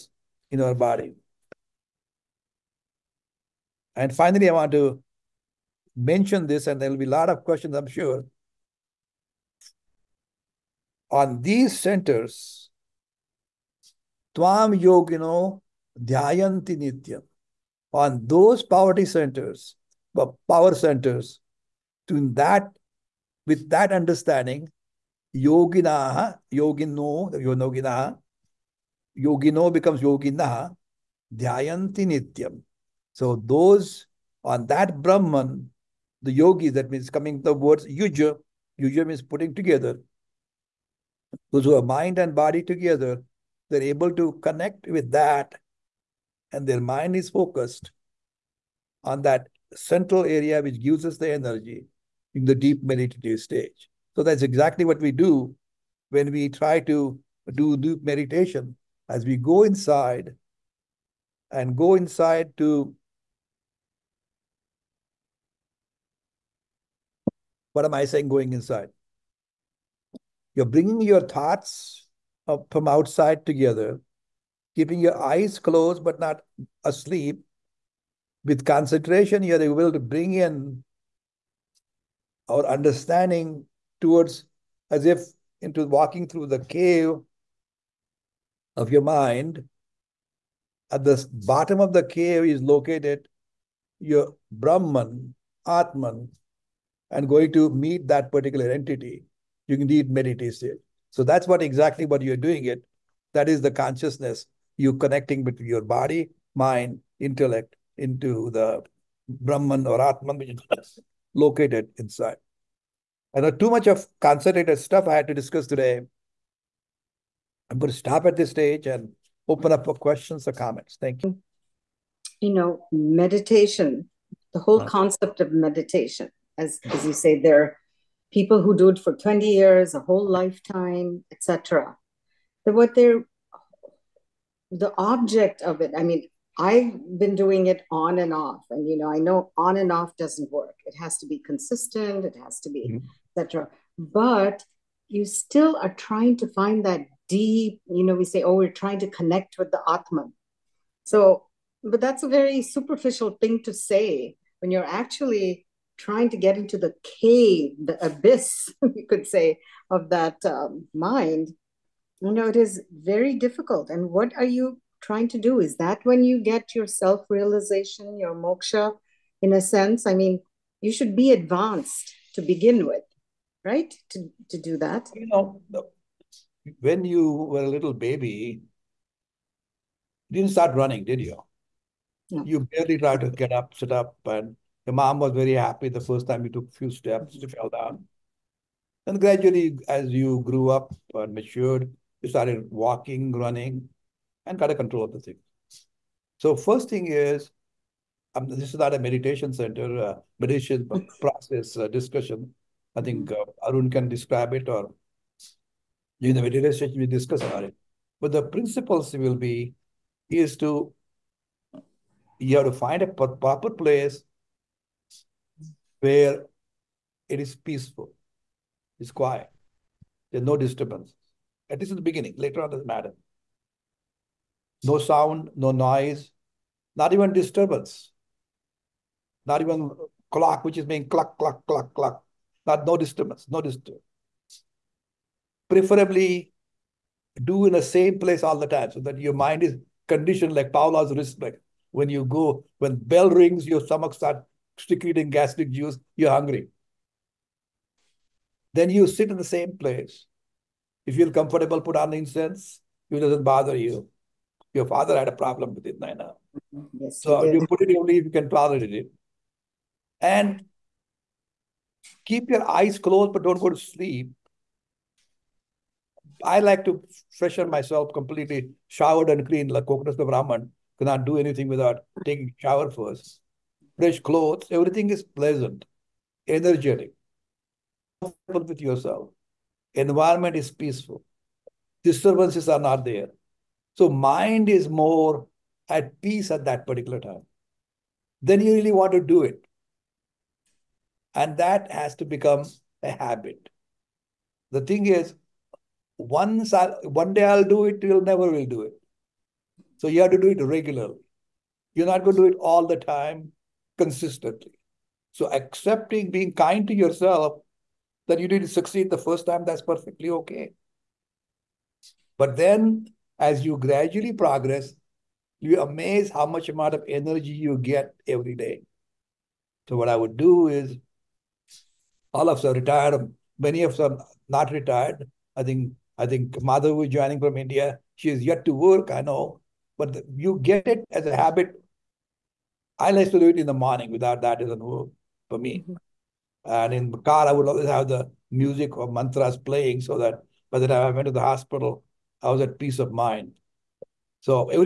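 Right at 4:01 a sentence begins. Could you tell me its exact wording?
When you go, when bell rings, your stomach starts secreting gastric juice, you're hungry.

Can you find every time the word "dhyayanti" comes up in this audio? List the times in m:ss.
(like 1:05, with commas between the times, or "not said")
0:16, 0:31.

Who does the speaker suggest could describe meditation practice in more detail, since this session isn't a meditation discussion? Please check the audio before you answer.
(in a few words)
Arun.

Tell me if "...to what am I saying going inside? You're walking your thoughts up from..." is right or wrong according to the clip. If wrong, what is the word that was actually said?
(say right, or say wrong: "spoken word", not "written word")
wrong: "bringing", not "walking".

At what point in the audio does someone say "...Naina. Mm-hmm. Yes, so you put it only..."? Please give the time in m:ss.
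4:15.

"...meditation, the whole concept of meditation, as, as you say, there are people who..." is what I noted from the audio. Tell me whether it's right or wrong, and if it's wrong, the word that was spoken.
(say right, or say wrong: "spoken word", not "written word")
right.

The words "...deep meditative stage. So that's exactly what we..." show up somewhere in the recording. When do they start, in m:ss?
0:52.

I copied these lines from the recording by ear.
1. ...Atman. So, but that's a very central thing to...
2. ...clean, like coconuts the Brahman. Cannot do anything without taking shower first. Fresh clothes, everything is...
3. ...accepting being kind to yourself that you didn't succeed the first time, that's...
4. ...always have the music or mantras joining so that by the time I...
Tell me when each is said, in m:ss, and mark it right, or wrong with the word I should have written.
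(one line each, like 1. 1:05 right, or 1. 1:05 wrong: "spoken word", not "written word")
1. 2:29 wrong: "superficial", not "central"
2. 4:29 right
3. 5:05 right
4. 5:37 wrong: "playing", not "joining".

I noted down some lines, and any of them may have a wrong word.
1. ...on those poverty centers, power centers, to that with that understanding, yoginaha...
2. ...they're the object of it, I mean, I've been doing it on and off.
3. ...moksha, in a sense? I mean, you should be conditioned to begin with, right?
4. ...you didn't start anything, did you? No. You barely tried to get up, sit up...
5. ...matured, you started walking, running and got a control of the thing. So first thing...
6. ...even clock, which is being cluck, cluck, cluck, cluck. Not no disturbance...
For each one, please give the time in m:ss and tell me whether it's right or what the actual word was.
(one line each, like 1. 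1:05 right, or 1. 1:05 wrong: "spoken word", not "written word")
1. 0:17 right
2. 2:12 right
3. 2:48 wrong: "advanced", not "conditioned"
4. 3:00 wrong: "running", not "anything"
5. 3:11 right
6. 3:49 right.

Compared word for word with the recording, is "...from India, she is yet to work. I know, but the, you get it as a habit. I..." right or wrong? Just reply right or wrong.
right.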